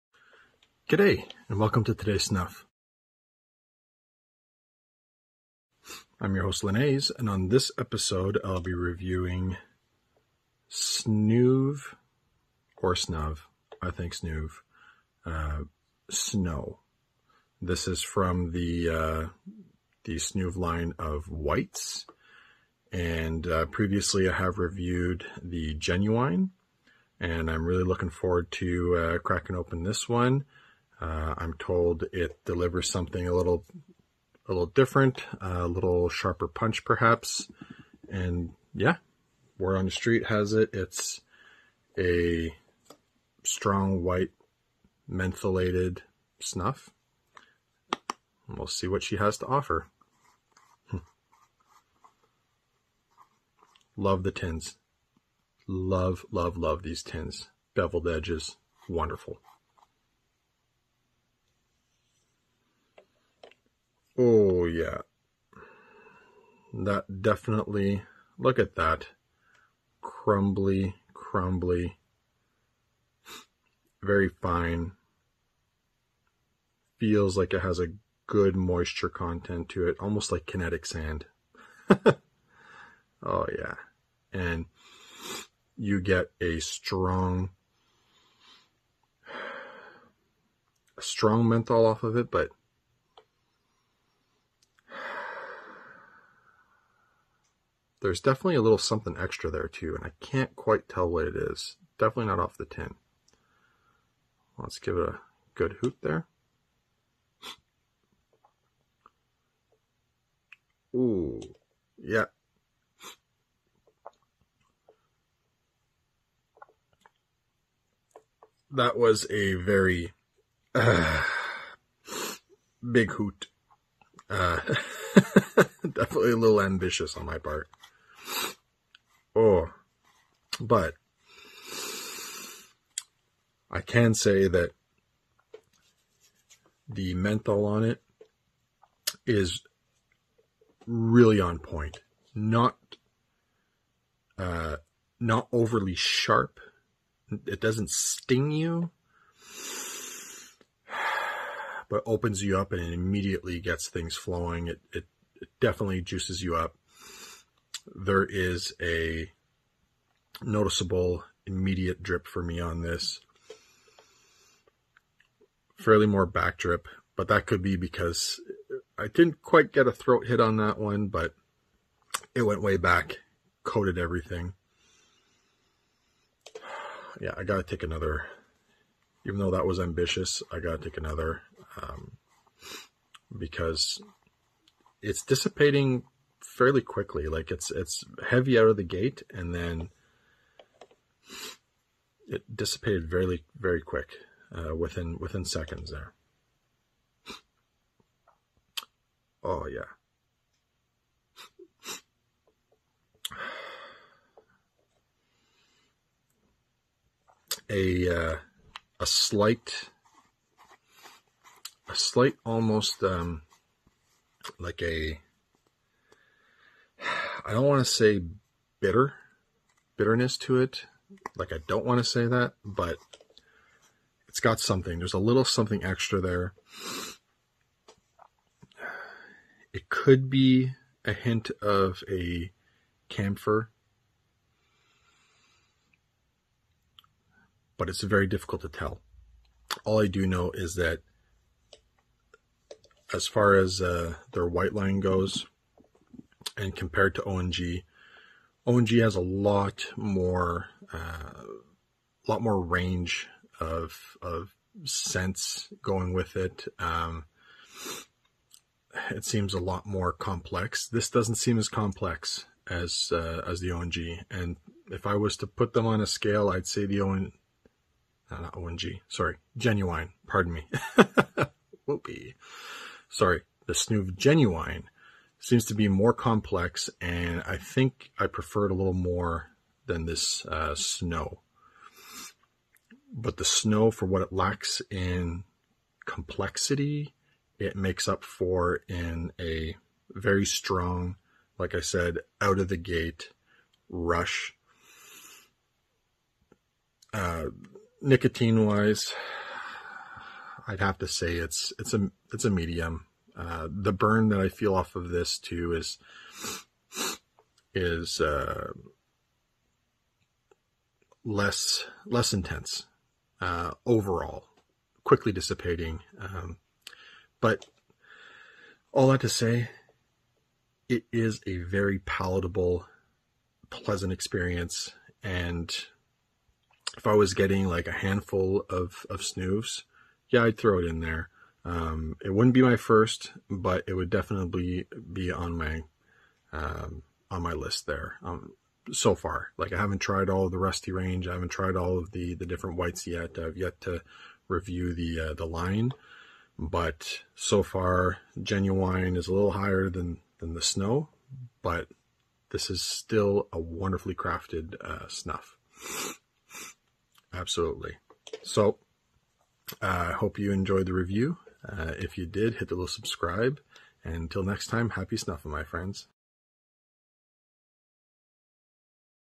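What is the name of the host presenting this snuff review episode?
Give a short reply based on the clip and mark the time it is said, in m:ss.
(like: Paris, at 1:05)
Linnaeus, at 0:06.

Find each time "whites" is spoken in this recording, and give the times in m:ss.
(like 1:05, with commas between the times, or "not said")
0:21, 0:44, 4:04, 5:42.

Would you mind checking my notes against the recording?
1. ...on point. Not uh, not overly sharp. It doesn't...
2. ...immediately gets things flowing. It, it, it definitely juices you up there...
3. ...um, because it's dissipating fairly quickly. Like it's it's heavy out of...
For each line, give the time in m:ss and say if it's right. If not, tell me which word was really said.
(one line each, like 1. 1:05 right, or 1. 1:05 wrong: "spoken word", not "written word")
1. 2:21 right
2. 2:32 right
3. 3:01 right.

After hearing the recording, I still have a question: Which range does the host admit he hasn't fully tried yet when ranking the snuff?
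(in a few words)
Rusty range.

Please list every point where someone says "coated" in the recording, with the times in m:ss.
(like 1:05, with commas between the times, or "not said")
2:53.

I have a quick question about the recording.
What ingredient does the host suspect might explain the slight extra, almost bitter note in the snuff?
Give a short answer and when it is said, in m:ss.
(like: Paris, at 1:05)
Camphor, at 3:53.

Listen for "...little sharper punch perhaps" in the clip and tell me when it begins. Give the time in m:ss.
0:35.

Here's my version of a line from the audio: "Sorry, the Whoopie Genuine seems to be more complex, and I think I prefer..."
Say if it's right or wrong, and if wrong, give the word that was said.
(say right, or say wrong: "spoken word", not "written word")
wrong: "Snoove", not "Whoopie".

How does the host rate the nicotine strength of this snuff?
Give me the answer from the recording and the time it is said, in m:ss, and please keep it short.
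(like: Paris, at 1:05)
Medium, at 5:02.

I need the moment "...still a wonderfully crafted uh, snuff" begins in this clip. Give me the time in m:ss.
5:52.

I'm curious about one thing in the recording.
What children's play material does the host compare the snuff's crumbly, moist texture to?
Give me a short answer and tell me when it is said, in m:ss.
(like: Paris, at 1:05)
Kinetic sand, at 1:20.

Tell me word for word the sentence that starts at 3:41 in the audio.
Like I don't want to say that, but it's got something.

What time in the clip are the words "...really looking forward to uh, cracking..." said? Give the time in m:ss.
0:27.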